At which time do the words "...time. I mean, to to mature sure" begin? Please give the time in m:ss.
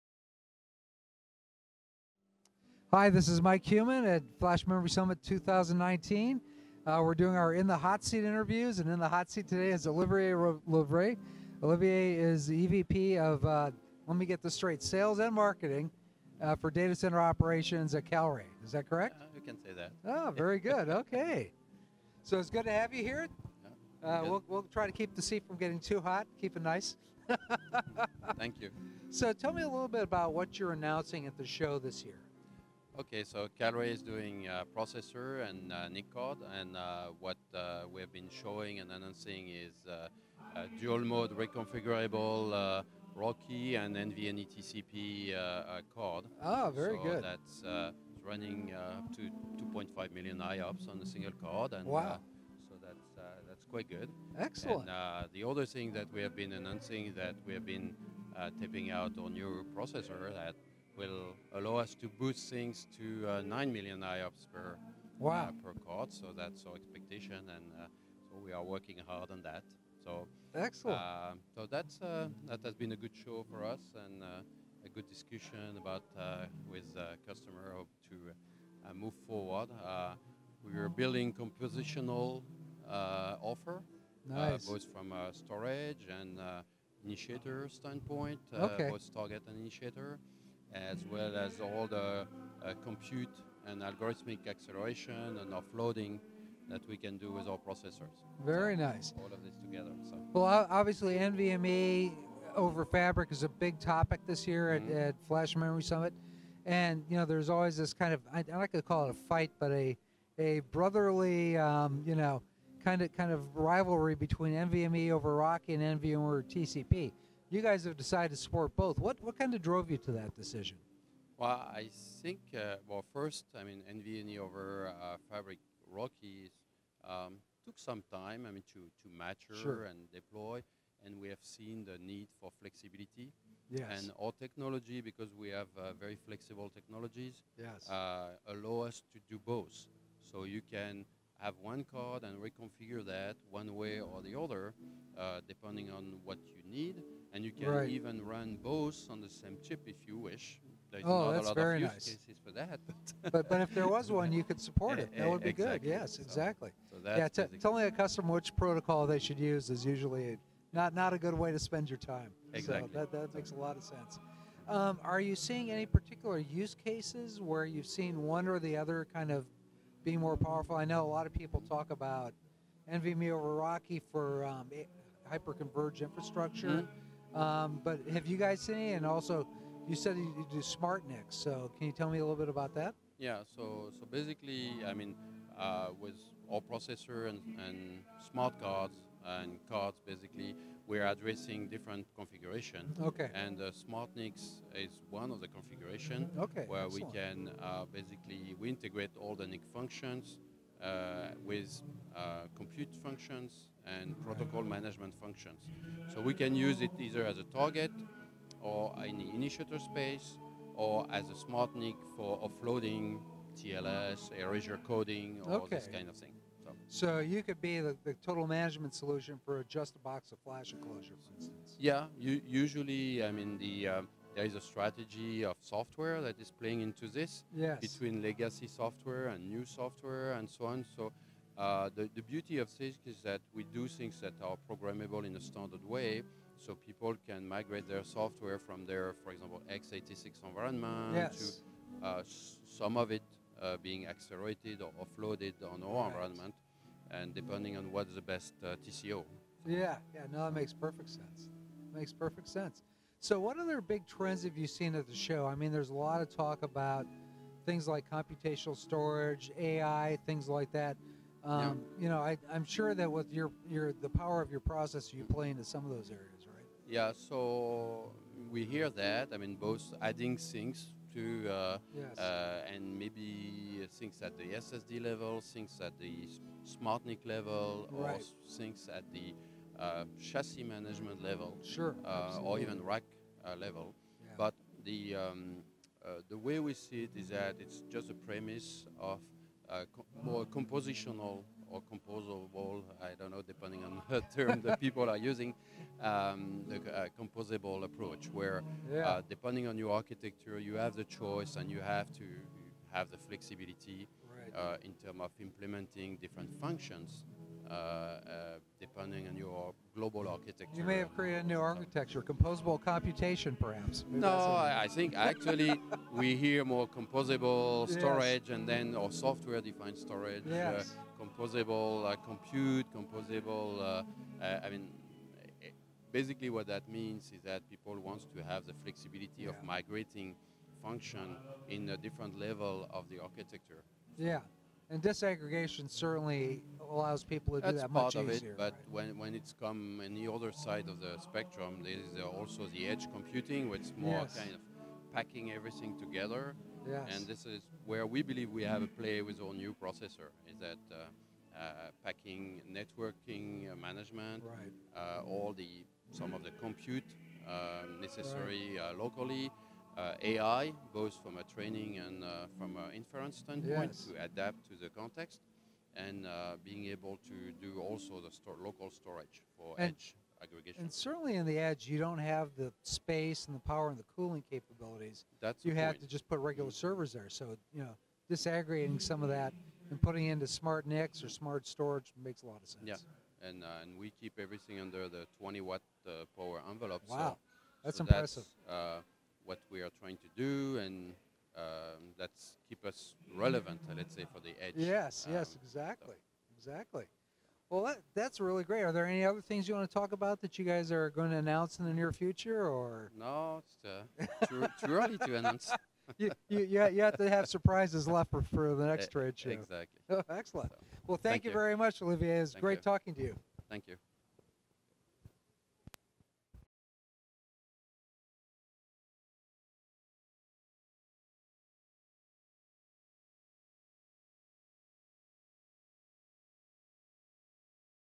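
2:08.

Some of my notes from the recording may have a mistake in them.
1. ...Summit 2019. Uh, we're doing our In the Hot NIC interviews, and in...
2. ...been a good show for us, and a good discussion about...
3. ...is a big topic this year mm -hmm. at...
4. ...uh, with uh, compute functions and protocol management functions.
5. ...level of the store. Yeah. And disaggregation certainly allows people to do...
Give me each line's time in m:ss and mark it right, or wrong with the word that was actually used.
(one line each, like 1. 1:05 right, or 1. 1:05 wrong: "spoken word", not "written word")
1. 0:04 wrong: "Seat", not "NIC"
2. 1:12 right
3. 1:43 right
4. 3:20 right
5. 5:32 wrong: "architecture", not "store".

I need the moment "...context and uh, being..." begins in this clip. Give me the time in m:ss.
6:04.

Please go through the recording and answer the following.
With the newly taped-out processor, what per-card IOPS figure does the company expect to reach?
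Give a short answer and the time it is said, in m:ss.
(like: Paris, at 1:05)
9 million, at 1:03.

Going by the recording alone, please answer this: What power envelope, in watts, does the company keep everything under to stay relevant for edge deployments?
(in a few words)
20 watts.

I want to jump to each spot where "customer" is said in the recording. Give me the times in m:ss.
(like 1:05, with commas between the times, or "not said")
1:17, 2:37.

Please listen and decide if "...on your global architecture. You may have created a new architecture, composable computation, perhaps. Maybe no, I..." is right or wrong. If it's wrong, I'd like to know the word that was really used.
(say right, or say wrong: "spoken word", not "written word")
right.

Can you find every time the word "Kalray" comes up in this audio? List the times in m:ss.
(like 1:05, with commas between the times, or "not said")
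0:18, 0:33.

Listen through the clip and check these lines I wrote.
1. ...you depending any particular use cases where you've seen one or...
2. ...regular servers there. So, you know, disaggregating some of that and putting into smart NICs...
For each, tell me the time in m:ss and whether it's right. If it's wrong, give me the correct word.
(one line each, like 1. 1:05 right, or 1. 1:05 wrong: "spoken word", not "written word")
1. 2:45 wrong: "seeing", not "depending"
2. 6:16 right.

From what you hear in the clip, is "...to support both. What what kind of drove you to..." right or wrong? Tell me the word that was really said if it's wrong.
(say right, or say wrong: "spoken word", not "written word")
right.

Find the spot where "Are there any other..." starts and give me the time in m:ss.
6:38.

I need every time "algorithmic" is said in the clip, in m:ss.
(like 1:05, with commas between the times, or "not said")
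1:33.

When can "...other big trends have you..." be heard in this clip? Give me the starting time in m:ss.
4:13.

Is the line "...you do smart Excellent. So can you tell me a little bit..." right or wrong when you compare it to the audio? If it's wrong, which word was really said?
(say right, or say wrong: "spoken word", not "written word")
wrong: "NICs", not "Excellent".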